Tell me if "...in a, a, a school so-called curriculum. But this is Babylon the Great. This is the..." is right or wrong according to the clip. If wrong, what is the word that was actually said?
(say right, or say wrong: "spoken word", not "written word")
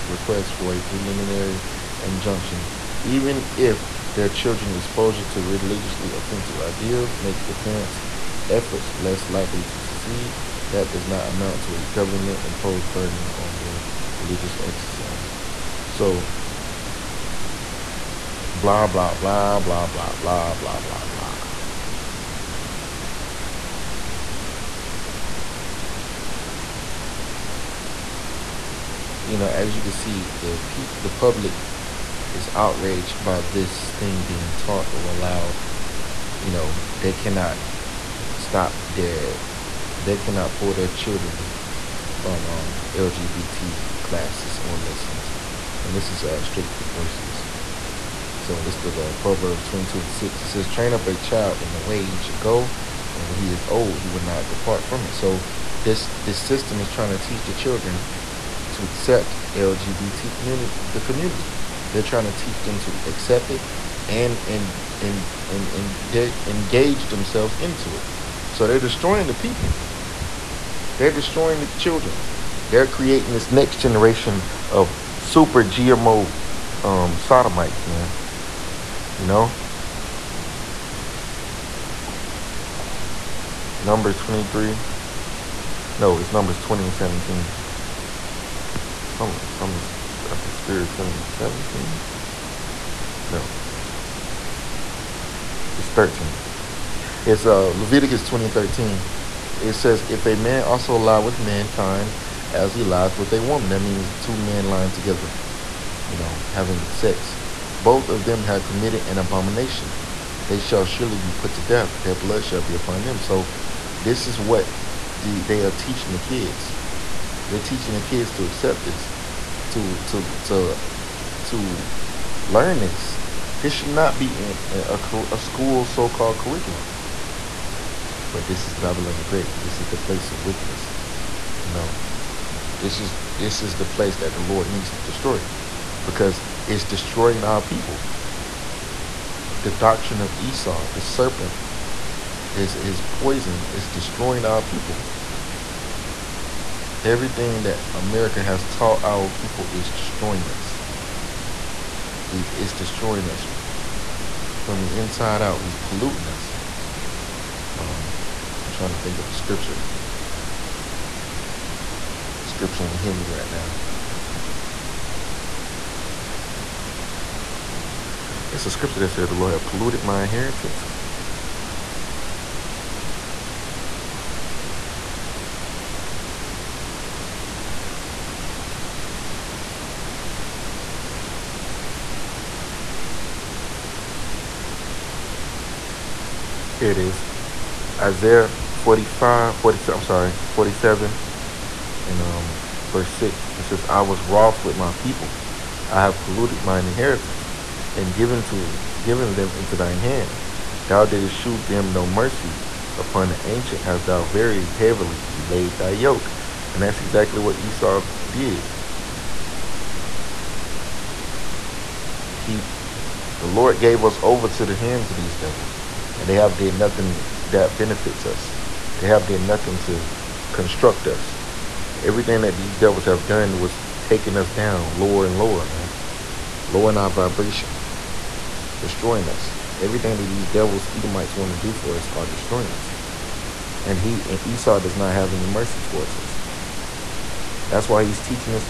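right.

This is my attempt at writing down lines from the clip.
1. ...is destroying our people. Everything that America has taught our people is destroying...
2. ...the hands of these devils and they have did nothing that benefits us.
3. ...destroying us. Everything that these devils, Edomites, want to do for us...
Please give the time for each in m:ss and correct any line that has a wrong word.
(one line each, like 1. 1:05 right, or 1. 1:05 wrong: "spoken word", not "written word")
1. 2:23 right
2. 3:34 right
3. 3:48 right.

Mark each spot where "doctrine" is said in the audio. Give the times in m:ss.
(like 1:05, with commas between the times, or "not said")
2:19.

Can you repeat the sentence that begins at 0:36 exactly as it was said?
You know, they cannot stop their, they cannot pull their children from um, LGBT classes or lessons.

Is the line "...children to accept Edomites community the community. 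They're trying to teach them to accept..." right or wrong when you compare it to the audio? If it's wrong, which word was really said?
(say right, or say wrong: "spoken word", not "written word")
wrong: "LGBT", not "Edomites".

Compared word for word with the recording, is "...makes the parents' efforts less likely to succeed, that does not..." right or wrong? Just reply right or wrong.
right.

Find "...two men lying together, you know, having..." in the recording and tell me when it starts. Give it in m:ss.
1:44.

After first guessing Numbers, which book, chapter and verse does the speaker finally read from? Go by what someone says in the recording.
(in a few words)
Leviticus 20:13.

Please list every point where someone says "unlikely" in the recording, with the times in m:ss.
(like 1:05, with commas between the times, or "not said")
not said.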